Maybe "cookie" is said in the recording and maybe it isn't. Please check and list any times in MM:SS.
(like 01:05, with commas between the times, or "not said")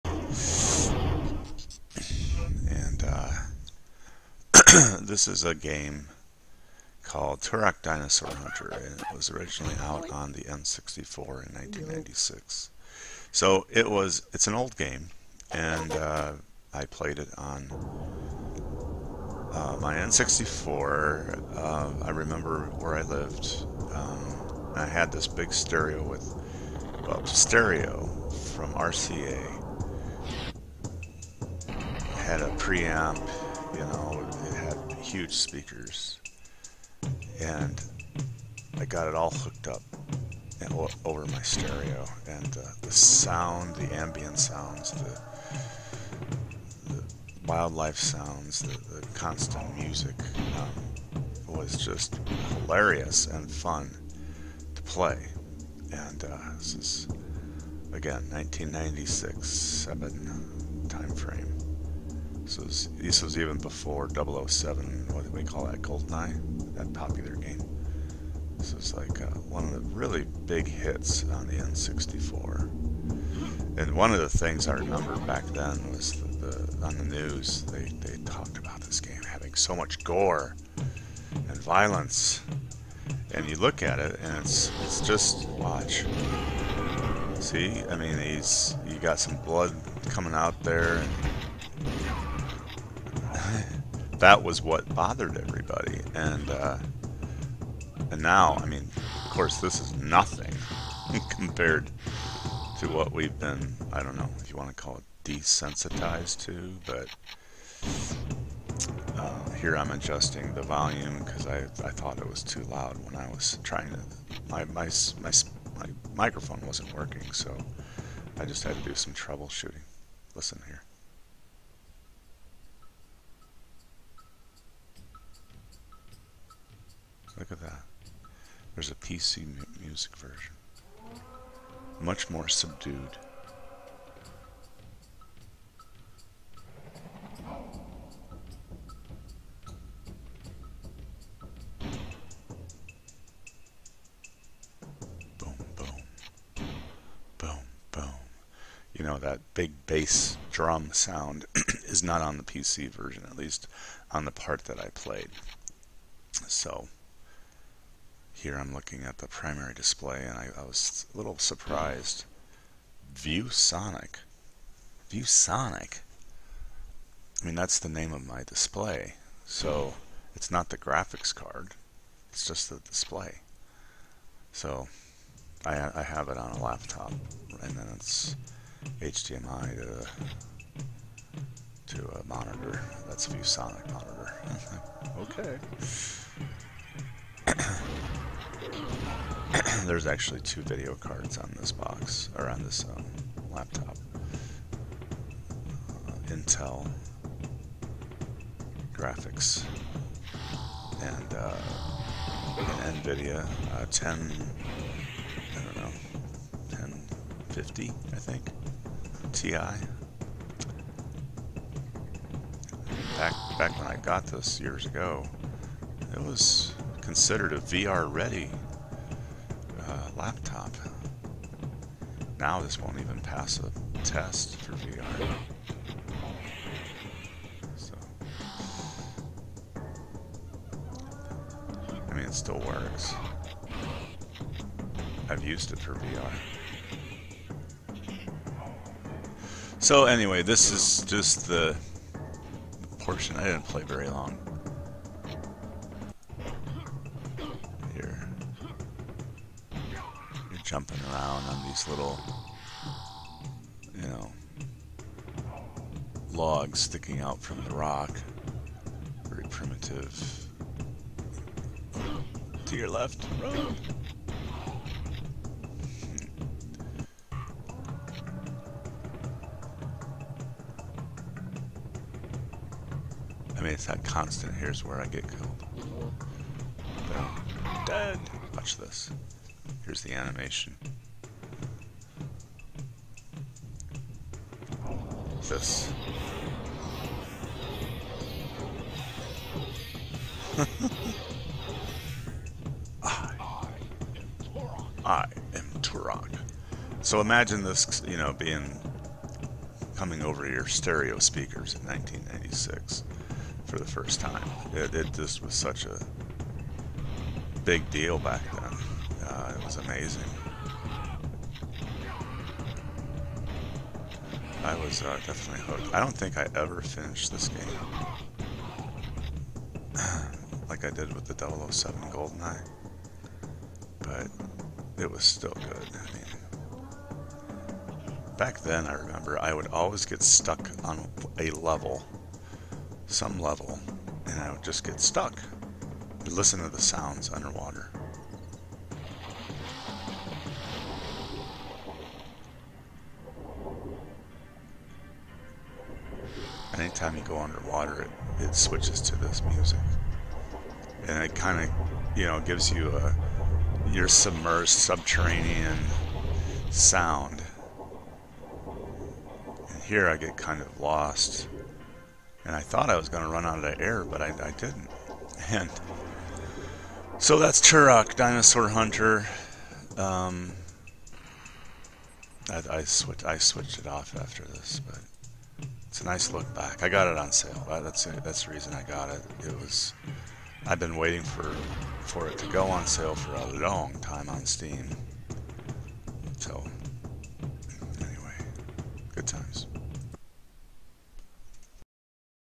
not said.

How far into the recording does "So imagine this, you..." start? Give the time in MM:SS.
04:57.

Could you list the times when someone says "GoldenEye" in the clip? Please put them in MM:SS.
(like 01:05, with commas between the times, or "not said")
01:05, 05:22.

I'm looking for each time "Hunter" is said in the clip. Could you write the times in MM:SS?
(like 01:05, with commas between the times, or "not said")
00:08, 06:08.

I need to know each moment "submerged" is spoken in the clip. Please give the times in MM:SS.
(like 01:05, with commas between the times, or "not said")
05:54.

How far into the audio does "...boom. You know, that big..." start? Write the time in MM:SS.
02:27.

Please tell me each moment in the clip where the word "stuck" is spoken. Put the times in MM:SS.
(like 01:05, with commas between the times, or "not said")
05:30, 05:34.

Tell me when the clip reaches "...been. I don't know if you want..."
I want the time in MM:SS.
01:43.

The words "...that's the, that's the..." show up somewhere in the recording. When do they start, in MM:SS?
06:17.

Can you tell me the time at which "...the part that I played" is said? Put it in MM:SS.
02:34.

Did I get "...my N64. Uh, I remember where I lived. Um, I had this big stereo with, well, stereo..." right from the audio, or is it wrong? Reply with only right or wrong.
right.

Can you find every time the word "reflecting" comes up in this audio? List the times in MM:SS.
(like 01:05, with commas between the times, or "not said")
not said.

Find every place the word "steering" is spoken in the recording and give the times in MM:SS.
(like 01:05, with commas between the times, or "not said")
not said.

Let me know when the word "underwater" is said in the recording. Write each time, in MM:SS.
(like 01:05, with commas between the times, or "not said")
05:37, 05:47.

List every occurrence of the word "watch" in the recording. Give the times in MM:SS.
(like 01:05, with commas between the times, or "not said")
01:25, 04:38.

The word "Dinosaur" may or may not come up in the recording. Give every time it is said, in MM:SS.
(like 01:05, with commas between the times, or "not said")
00:07, 06:08.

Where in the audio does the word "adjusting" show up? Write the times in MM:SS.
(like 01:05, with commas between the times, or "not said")
01:49.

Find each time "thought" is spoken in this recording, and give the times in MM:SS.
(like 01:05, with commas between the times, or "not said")
01:51, 06:02.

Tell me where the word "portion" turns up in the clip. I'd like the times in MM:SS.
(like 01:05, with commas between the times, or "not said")
04:02.